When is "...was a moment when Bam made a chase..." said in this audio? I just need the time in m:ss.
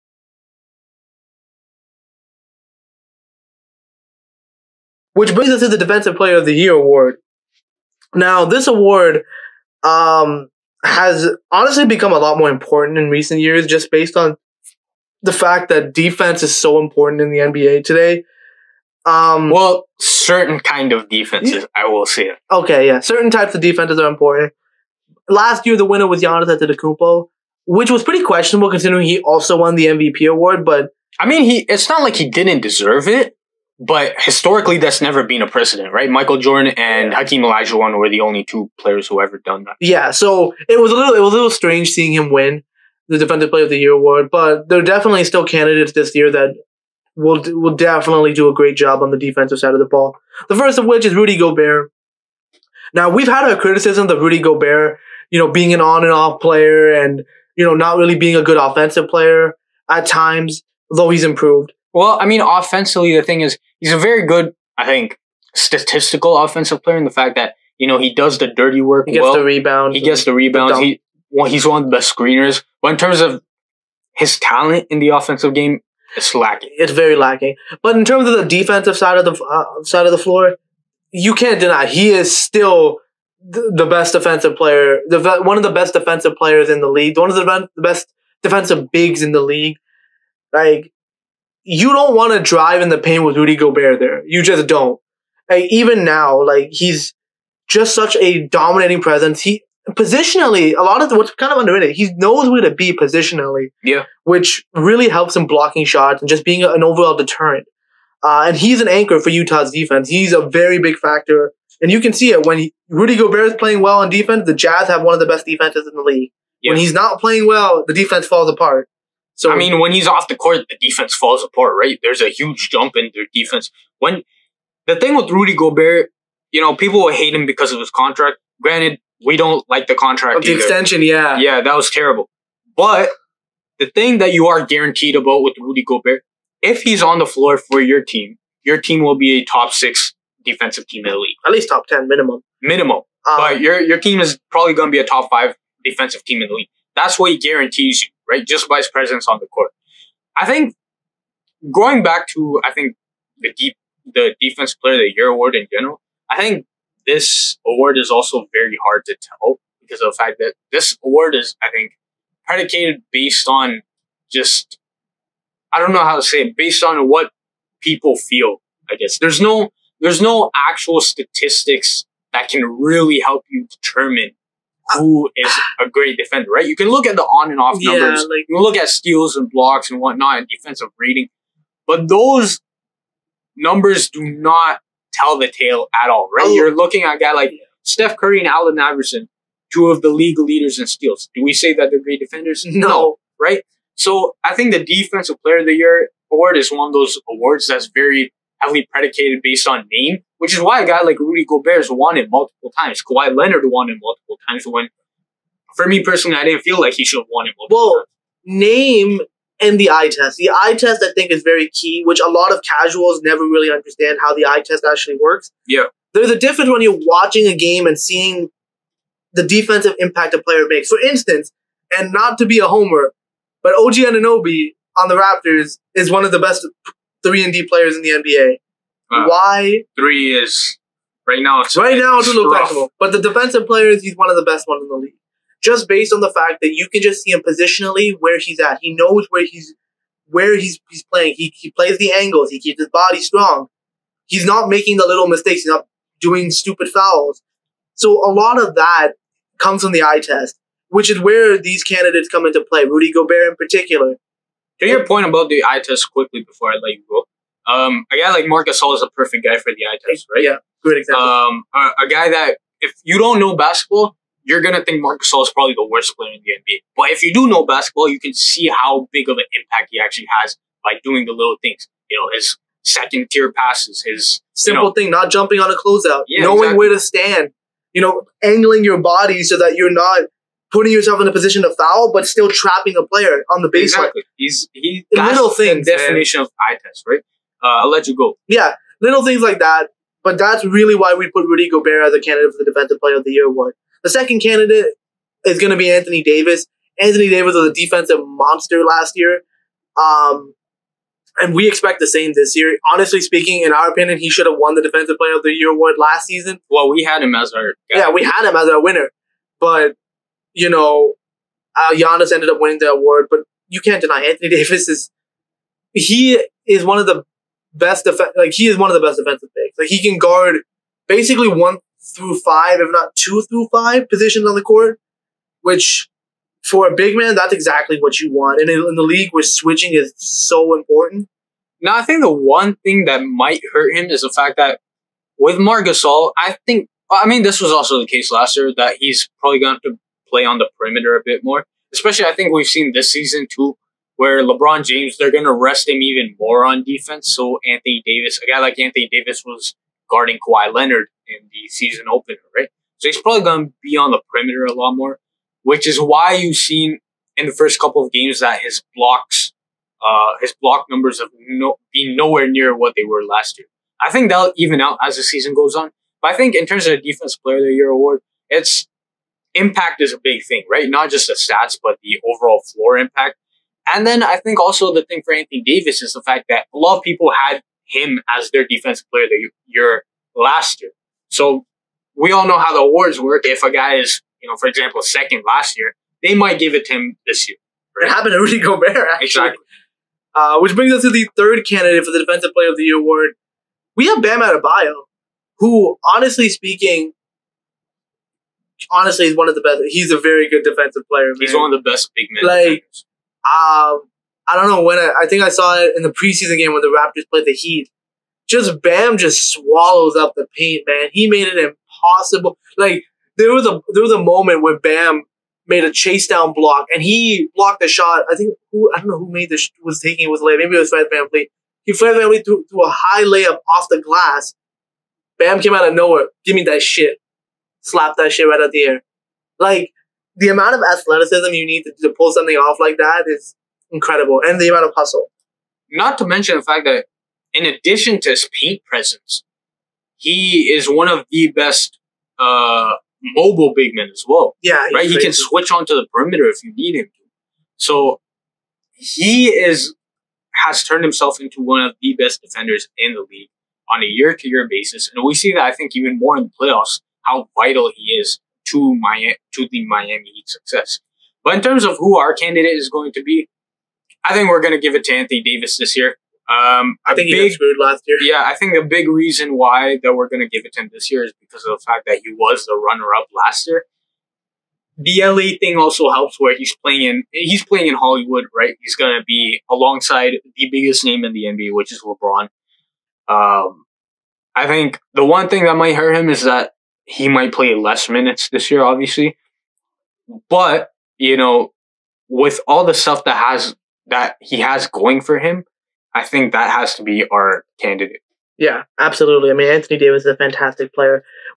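6:54.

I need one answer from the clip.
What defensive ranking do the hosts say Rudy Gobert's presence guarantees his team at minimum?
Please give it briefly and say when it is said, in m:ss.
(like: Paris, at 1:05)
top 10, at 2:21.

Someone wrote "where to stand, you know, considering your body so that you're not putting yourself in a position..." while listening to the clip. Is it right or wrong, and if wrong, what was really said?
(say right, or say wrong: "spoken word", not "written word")
wrong: "angling", not "considering".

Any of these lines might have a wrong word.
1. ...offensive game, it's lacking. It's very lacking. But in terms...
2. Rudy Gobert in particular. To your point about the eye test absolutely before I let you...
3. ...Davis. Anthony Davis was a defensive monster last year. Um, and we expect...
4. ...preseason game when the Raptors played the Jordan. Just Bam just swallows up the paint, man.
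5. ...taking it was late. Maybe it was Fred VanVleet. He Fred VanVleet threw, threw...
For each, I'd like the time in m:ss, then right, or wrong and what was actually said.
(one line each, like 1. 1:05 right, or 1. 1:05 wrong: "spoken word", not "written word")
1. 1:15 right
2. 4:12 wrong: "quickly", not "absolutely"
3. 4:56 right
4. 6:46 wrong: "Heat", not "Jordan"
5. 7:00 right.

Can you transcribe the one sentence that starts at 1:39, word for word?
He positionally, a lot of what's kind of underrated, he knows where to be positionally.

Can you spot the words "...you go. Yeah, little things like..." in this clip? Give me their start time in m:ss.
4:48.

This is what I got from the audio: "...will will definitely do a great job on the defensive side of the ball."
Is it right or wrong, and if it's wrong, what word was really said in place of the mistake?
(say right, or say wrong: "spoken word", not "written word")
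right.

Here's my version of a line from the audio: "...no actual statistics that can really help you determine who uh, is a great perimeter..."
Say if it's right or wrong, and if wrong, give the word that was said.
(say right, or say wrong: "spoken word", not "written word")
wrong: "defender", not "perimeter".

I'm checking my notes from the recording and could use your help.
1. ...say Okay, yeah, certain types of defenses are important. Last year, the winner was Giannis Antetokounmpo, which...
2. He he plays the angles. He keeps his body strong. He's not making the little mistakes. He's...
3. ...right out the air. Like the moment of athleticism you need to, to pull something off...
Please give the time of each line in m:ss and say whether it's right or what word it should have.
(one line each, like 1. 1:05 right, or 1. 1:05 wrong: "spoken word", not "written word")
1. 0:22 right
2. 4:01 right
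3. 7:08 wrong: "amount", not "moment".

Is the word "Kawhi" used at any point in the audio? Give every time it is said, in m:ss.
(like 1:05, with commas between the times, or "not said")
3:23, 5:50.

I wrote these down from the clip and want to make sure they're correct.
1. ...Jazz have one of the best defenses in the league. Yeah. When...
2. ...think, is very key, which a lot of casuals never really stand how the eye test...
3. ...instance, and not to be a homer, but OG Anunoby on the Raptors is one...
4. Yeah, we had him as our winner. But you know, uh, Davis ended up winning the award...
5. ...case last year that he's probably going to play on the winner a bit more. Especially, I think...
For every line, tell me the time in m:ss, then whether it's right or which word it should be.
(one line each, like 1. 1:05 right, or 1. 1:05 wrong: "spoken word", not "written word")
1. 1:54 right
2. 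3:31 wrong: "understand", not "stand"
3. 3:40 right
4. 5:08 wrong: "Giannis", not "Davis"
5. 5:38 wrong: "perimeter", not "winner".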